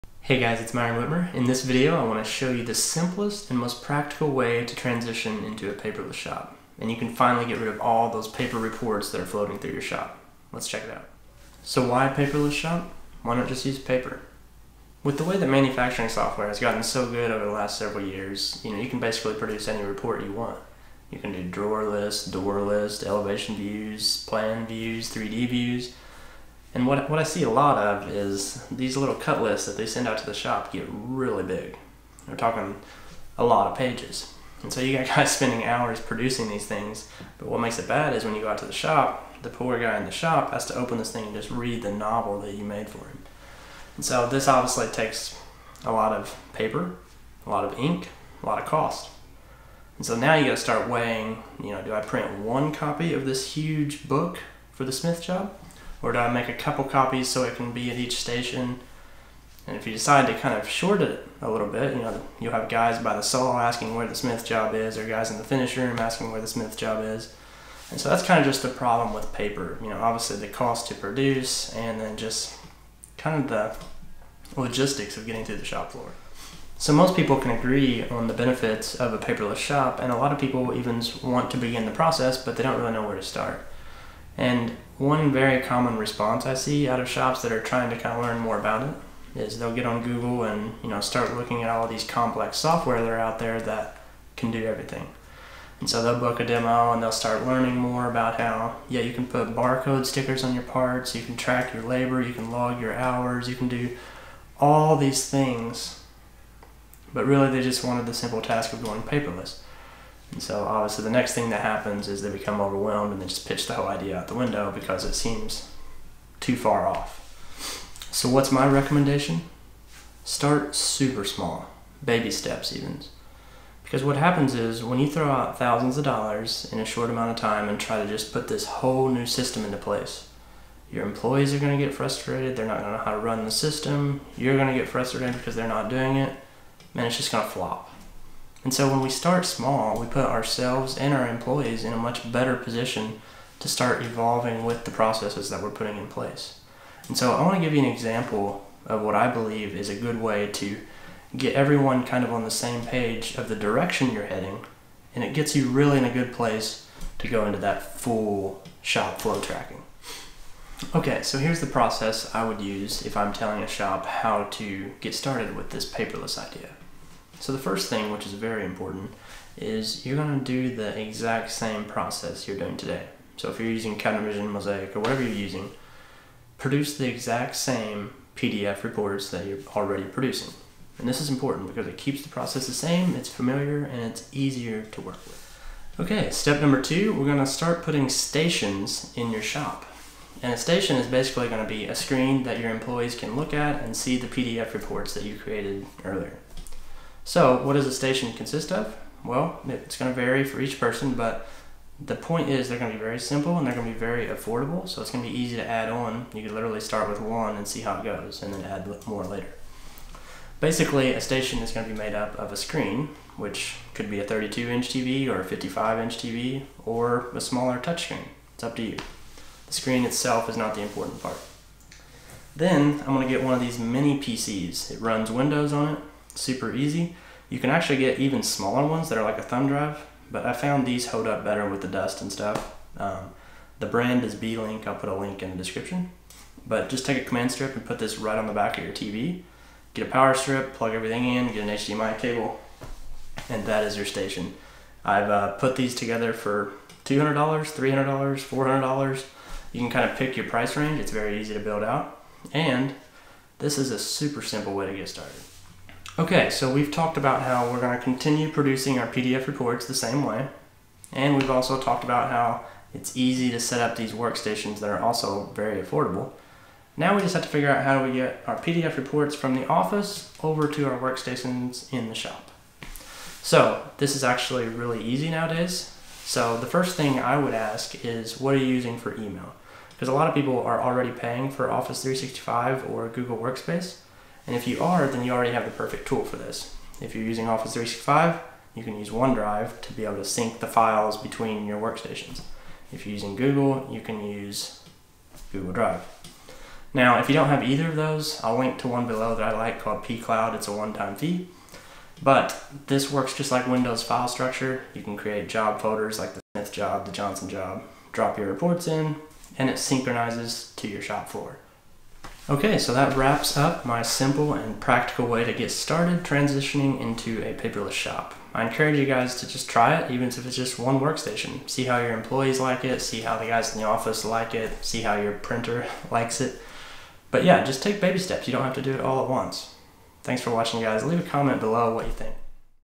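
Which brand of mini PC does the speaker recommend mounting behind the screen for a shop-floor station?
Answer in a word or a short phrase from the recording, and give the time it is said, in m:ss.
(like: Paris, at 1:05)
Beelink, at 3:54.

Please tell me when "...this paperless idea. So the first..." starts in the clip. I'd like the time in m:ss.
2:45.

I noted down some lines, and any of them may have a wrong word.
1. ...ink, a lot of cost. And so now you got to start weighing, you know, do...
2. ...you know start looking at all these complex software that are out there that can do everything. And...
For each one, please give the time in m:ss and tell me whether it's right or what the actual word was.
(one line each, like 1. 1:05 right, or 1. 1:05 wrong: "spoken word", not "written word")
1. 0:47 right
2. 1:30 right.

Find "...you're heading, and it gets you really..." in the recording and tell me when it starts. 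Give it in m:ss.
2:34.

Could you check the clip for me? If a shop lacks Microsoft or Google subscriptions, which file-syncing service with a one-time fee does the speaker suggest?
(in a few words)
pCloud.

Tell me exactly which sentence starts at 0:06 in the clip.
And you can finally get rid of all those paper reports that are floating through your shop.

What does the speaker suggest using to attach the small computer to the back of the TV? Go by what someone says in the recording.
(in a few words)
command strip.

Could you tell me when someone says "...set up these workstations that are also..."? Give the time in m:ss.
4:23.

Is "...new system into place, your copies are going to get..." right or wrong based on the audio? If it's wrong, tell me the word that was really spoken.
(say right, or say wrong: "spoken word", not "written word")
wrong: "employees", not "copies".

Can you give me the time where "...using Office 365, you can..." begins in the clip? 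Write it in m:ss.
4:47.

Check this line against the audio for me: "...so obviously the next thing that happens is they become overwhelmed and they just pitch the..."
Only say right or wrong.
right.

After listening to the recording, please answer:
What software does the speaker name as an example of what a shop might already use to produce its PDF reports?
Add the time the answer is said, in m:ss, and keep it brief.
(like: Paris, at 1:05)
Counter Mozaik, at 2:53.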